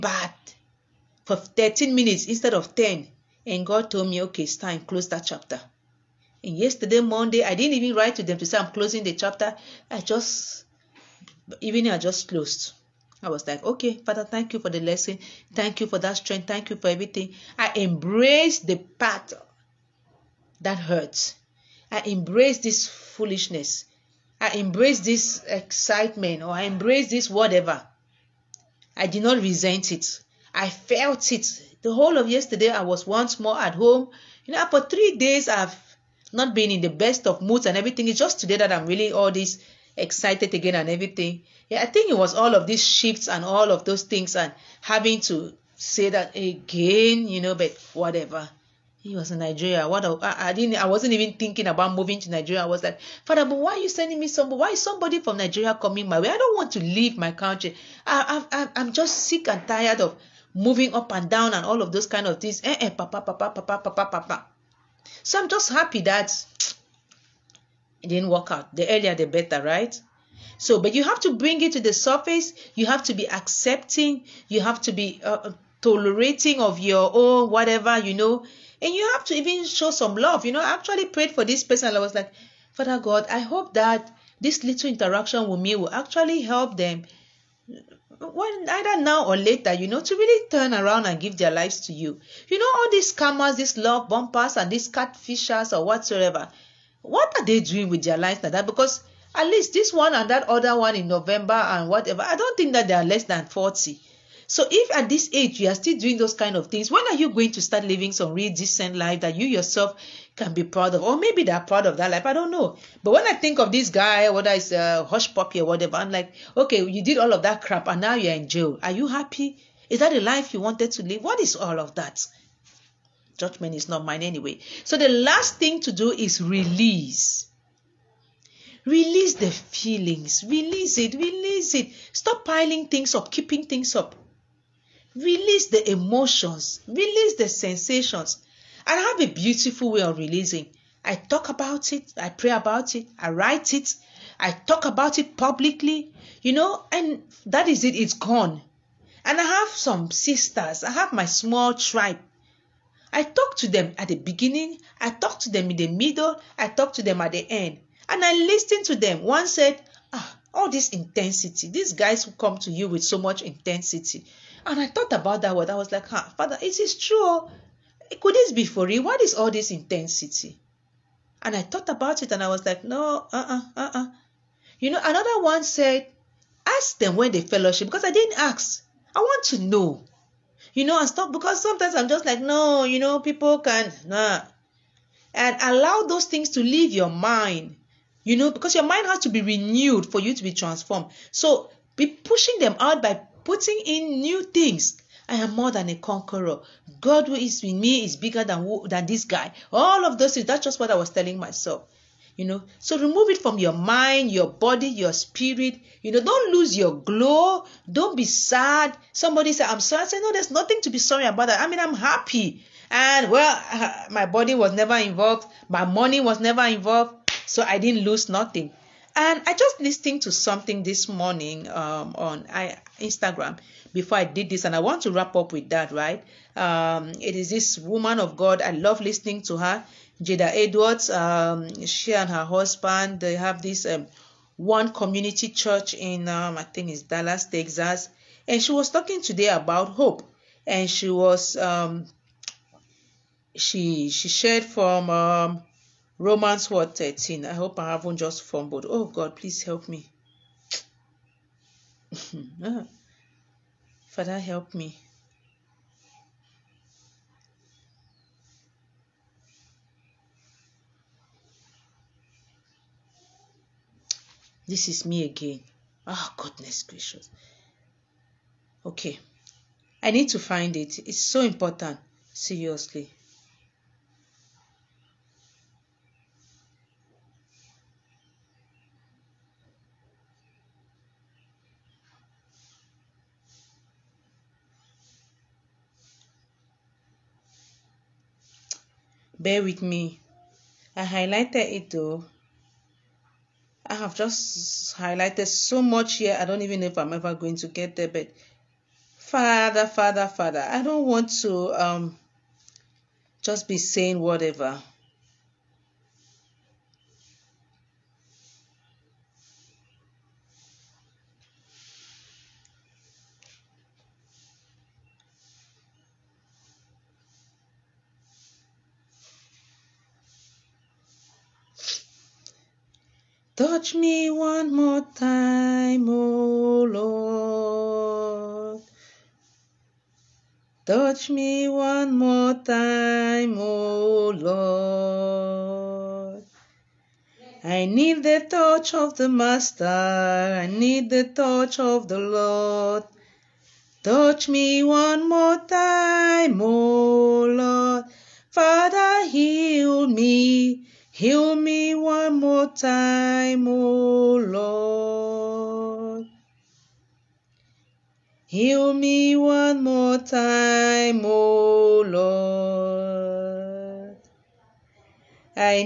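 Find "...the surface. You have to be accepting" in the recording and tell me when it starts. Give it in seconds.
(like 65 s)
71 s.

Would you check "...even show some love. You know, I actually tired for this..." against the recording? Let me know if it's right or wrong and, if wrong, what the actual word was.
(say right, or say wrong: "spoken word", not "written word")
wrong: "prayed", not "tired".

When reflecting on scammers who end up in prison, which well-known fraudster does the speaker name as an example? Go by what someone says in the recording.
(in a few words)
Hushpuppi.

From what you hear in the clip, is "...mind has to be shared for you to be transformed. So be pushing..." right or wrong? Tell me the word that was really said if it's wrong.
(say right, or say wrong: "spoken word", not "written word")
wrong: "renewed", not "shared".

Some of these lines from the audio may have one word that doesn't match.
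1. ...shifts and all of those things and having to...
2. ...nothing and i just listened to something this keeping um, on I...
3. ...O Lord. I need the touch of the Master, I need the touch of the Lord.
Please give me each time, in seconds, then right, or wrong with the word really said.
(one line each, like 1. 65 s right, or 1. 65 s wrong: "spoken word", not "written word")
1. 42 s right
2. 218 s wrong: "morning", not "keeping"
3. 333 s right.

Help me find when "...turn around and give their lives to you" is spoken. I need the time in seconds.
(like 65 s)
90 s.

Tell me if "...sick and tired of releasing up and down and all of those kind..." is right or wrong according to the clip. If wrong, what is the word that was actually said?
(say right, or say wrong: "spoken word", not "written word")
wrong: "moving", not "releasing".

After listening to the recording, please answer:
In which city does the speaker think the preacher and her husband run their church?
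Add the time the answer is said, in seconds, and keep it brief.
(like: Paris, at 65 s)
Dallas, at 237 s.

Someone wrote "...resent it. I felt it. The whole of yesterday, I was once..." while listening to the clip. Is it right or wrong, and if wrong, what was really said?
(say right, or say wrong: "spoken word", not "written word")
right.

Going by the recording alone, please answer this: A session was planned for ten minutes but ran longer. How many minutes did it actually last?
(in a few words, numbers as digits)
13.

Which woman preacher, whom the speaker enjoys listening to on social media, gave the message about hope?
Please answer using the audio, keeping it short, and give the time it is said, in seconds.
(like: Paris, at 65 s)
Jada Edwards, at 230 s.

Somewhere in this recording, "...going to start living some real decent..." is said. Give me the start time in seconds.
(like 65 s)
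107 s.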